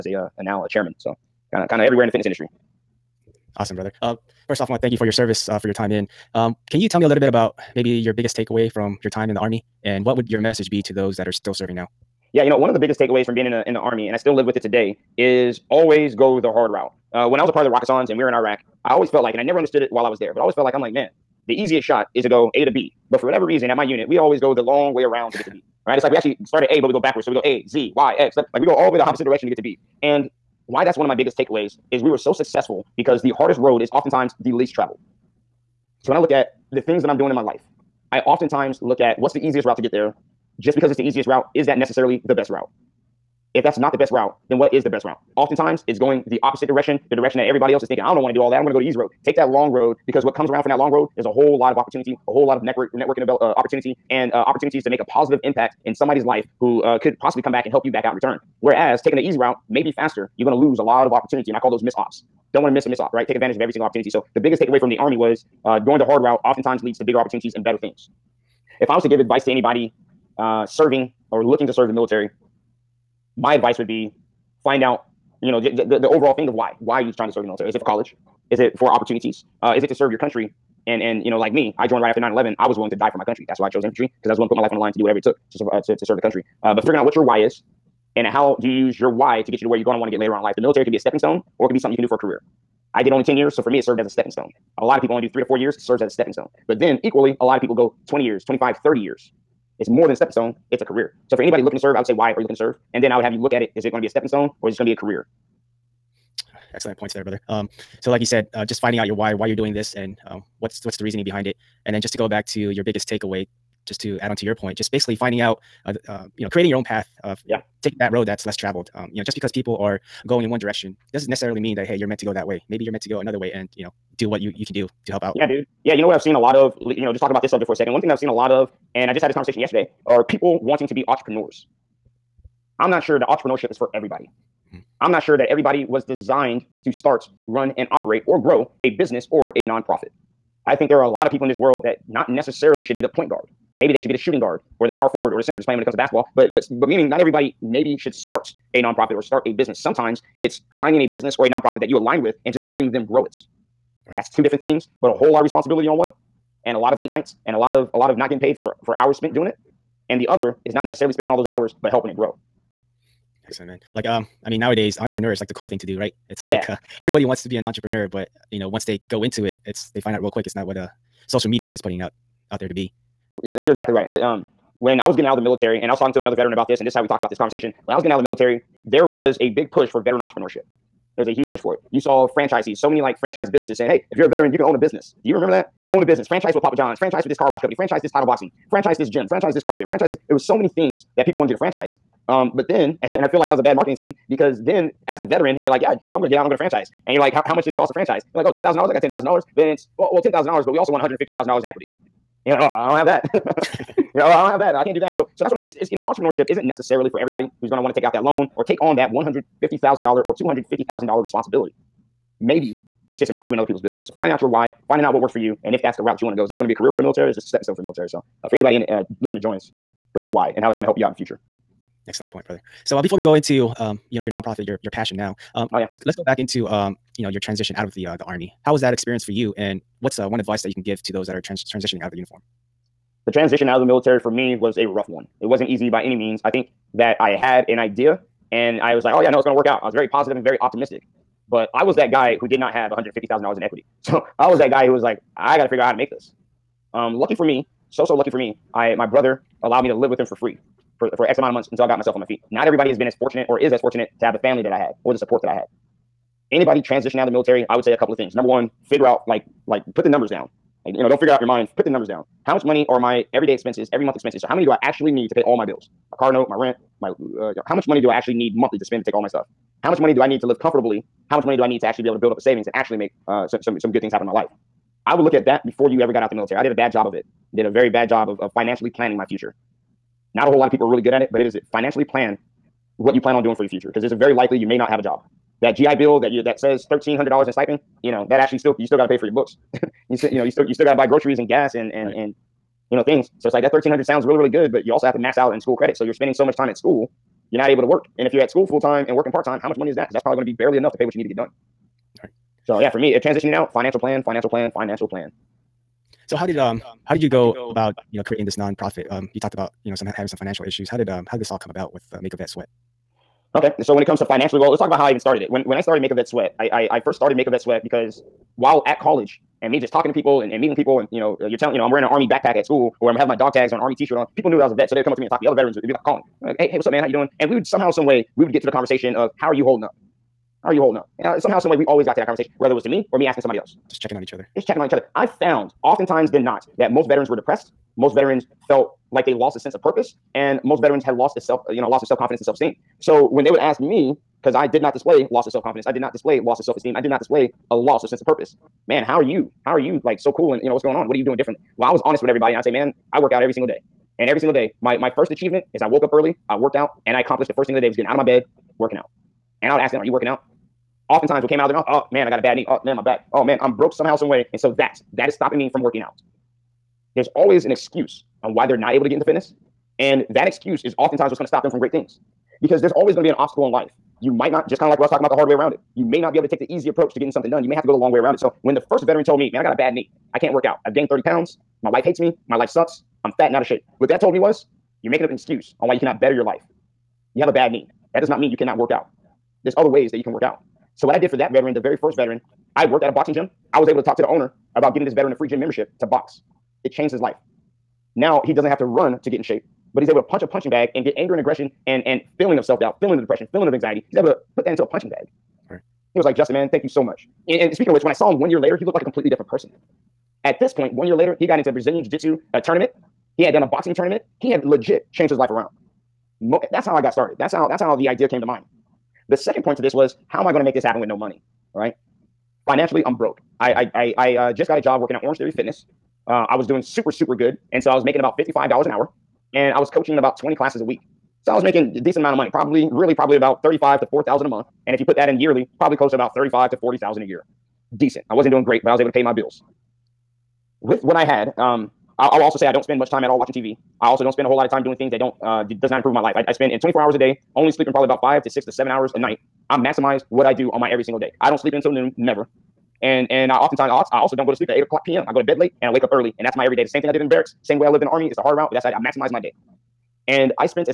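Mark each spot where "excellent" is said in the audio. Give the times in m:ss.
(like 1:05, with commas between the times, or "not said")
1:46, 2:43, 3:42.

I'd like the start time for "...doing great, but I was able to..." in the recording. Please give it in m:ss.
7:18.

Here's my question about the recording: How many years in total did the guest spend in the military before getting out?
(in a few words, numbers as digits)
10 years.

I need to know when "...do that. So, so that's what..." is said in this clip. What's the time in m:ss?
3:24.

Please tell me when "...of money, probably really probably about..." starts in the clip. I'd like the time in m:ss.
7:12.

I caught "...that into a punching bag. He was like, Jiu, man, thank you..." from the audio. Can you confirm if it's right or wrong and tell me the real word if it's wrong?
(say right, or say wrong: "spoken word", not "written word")
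wrong: "Justin", not "Jiu".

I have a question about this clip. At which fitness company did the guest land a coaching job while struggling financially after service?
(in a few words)
Orange Theory Fitness.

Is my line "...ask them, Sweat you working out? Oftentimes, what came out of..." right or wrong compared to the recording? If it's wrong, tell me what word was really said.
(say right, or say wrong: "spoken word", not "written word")
wrong: "Are", not "Sweat".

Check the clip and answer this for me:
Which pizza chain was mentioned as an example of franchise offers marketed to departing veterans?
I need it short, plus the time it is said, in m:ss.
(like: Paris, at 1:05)
Papa John's, at 3:06.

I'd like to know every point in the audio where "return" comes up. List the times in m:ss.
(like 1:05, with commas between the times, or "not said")
0:58.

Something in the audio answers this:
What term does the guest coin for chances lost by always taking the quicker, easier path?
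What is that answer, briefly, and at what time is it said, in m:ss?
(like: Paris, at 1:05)
miss ops, at 1:01.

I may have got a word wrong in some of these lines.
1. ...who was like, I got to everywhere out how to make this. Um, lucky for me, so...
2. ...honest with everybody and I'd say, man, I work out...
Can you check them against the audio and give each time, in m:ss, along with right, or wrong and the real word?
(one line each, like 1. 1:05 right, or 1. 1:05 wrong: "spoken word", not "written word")
1. 4:04 wrong: "figure", not "everywhere"
2. 5:52 right.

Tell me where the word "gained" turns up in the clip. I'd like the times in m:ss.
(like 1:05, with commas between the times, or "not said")
6:20.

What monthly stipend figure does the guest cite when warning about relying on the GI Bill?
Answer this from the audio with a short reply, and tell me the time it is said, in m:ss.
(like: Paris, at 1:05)
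$1,300, at 4:46.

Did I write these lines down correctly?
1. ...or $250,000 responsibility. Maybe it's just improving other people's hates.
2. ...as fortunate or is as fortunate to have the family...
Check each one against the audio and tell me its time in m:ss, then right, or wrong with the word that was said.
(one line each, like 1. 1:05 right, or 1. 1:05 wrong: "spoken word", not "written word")
1. 3:30 wrong: "businesses", not "hates"
2. 4:13 right.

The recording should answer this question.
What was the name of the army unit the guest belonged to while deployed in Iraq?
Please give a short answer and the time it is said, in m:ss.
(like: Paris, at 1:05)
Rakkasans, at 0:17.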